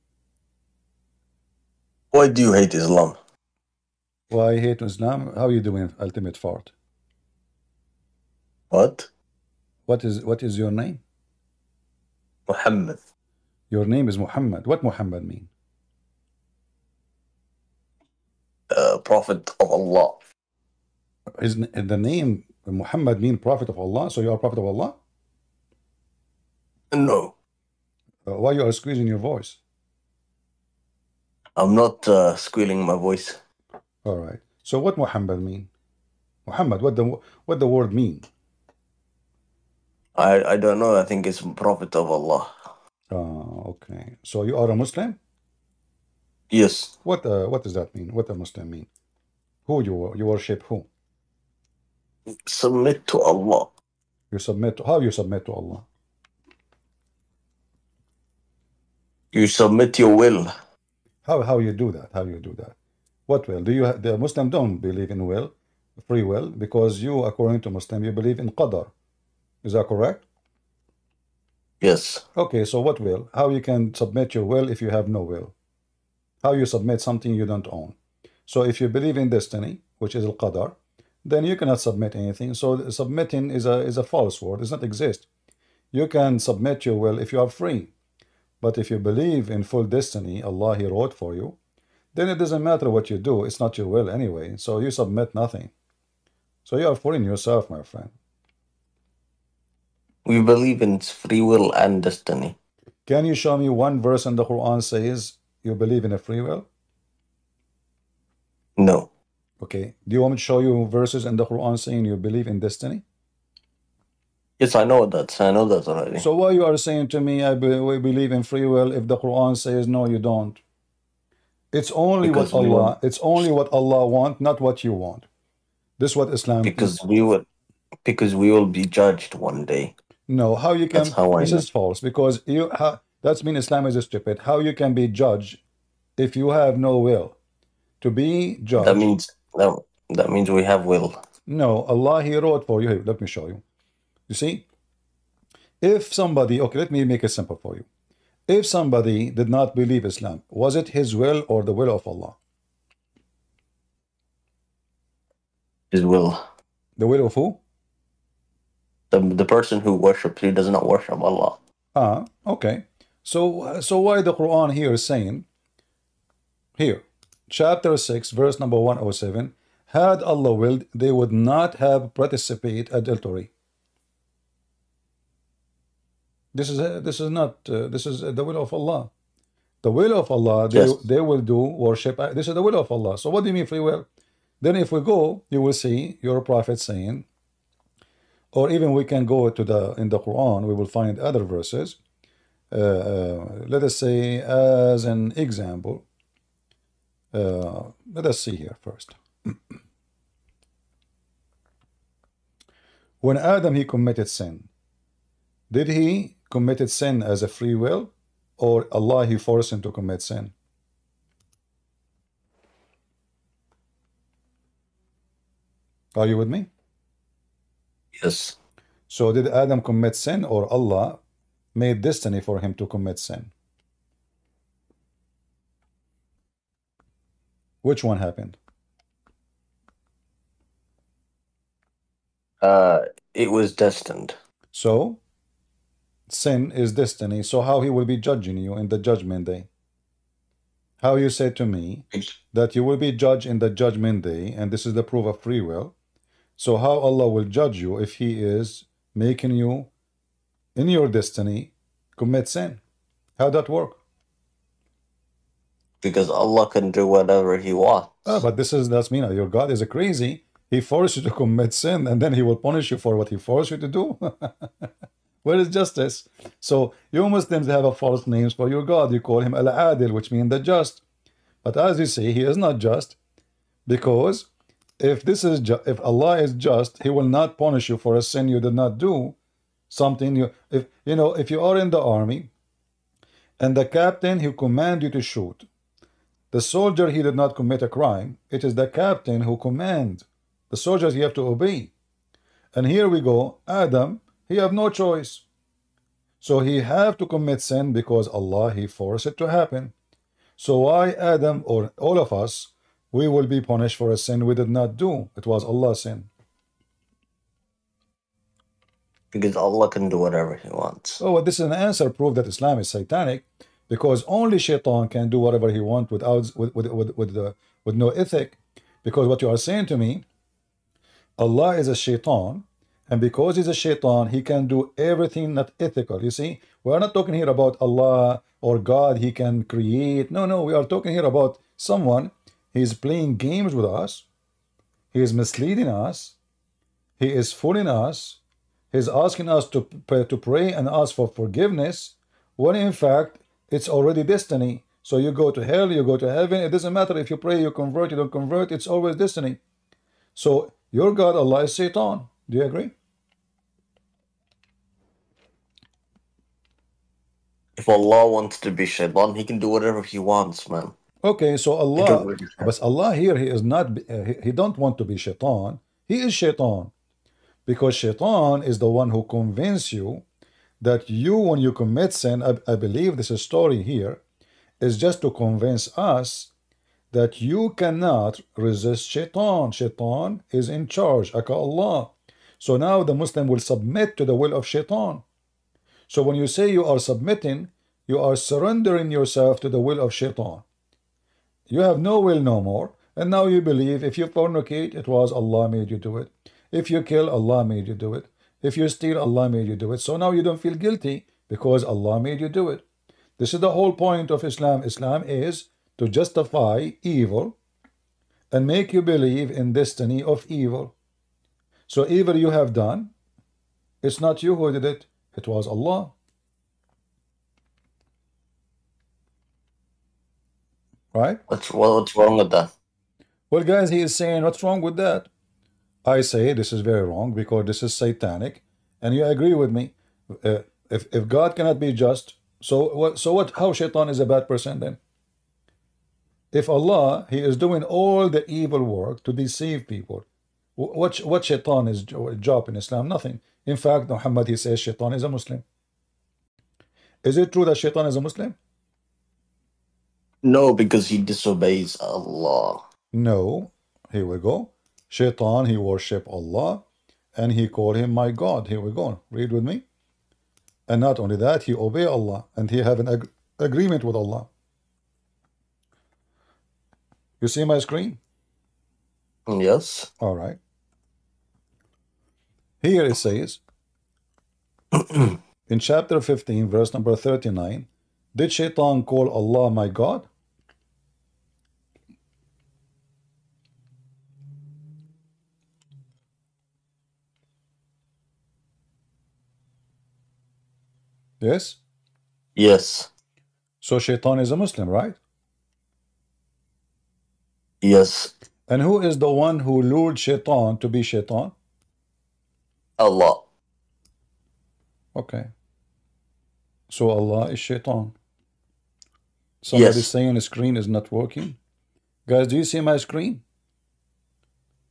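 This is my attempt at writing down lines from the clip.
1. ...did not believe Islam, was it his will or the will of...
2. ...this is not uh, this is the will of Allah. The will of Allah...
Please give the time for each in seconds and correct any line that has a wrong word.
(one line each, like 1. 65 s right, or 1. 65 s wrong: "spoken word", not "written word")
1. 149 s right
2. 177 s right.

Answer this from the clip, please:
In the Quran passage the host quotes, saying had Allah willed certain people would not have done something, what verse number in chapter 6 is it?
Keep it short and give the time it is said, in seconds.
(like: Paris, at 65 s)
107, at 168 s.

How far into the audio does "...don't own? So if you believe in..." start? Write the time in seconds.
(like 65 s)
77 s.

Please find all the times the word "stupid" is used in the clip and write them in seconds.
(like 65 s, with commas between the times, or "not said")
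134 s.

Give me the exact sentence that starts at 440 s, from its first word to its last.
What what Shaitan is job in Islam?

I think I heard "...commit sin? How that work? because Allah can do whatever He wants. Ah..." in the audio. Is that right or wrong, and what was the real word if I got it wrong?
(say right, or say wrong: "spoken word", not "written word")
right.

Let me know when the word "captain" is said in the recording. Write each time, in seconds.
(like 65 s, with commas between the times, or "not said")
283 s, 288 s.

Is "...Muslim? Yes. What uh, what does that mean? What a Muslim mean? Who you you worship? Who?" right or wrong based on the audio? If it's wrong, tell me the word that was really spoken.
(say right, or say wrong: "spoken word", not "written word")
right.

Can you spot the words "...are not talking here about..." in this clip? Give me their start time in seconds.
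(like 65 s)
326 s.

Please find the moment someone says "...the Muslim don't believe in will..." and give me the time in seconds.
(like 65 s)
63 s.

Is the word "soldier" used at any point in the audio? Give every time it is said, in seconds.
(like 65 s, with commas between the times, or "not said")
286 s, 290 s.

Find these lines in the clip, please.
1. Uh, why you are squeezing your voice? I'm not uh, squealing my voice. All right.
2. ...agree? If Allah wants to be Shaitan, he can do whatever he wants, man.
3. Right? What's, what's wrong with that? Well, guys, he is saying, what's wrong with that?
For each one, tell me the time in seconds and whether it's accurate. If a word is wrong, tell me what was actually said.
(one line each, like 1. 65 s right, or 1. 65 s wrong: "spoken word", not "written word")
1. 28 s right
2. 352 s right
3. 421 s right.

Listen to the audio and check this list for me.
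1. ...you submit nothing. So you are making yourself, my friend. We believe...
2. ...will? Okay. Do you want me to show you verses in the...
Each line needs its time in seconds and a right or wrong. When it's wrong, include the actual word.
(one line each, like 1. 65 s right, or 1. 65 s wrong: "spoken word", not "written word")
1. 94 s wrong: "fooling", not "making"
2. 106 s right.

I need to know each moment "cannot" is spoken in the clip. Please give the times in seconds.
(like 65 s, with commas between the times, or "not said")
81 s, 377 s, 431 s.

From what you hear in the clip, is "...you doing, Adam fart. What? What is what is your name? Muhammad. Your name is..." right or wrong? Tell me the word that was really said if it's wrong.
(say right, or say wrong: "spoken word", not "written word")
wrong: "Ultimate", not "Adam".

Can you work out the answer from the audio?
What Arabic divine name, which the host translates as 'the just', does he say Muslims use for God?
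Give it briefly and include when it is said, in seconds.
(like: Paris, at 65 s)
Al Adil, at 269 s.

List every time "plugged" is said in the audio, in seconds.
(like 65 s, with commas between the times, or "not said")
not said.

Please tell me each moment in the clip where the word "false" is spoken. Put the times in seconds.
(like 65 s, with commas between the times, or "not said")
84 s, 131 s, 267 s.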